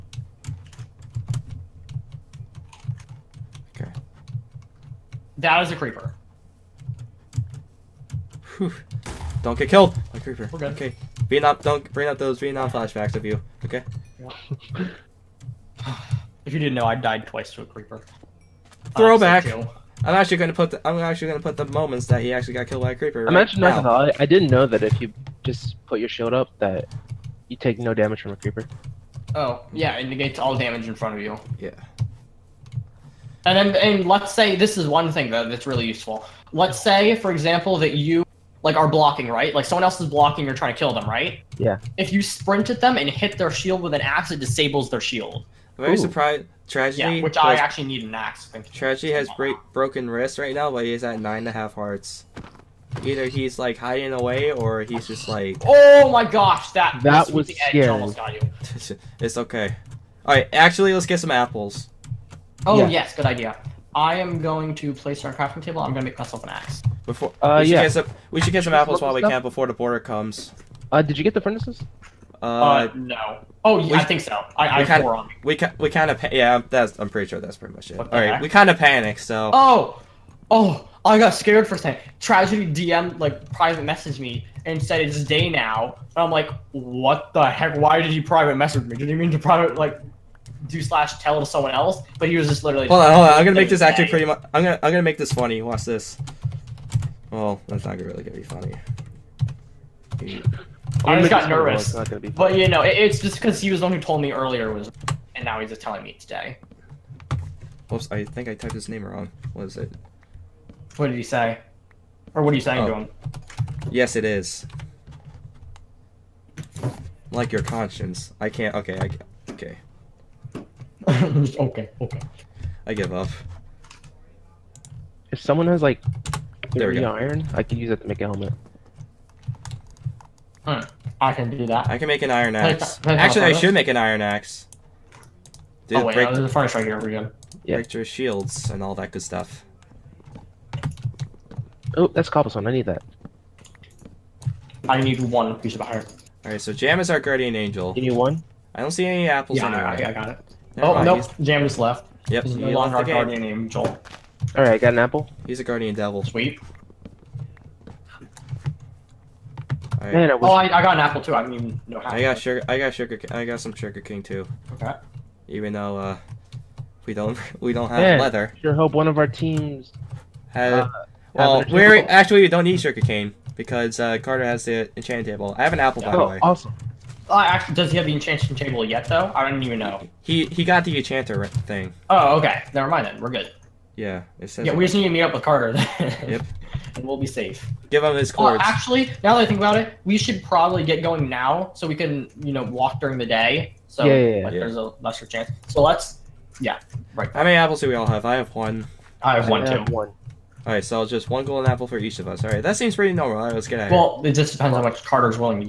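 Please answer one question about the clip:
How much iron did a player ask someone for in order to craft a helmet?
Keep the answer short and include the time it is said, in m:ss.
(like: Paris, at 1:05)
30, at 2:06.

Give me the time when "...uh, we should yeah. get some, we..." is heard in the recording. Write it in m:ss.
1:07.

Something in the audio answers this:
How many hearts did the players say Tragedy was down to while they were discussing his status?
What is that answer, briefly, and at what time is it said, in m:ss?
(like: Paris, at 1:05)
9.5, at 0:51.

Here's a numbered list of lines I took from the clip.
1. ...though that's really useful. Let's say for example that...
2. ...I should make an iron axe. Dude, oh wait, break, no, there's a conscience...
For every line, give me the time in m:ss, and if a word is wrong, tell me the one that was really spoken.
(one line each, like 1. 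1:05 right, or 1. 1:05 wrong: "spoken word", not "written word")
1. 0:35 right
2. 2:13 wrong: "furnace", not "conscience".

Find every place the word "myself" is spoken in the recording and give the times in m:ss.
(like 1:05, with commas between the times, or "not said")
1:06.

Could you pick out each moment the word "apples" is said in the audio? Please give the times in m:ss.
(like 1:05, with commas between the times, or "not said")
1:01, 1:08, 2:29, 2:34, 2:40, 2:55, 3:17, 3:21.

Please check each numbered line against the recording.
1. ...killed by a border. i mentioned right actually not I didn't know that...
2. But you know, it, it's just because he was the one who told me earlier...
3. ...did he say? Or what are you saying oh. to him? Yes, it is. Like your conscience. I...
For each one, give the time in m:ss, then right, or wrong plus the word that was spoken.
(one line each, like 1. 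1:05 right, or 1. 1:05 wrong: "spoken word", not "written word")
1. 0:22 wrong: "creeper", not "border"
2. 1:42 right
3. 1:51 right.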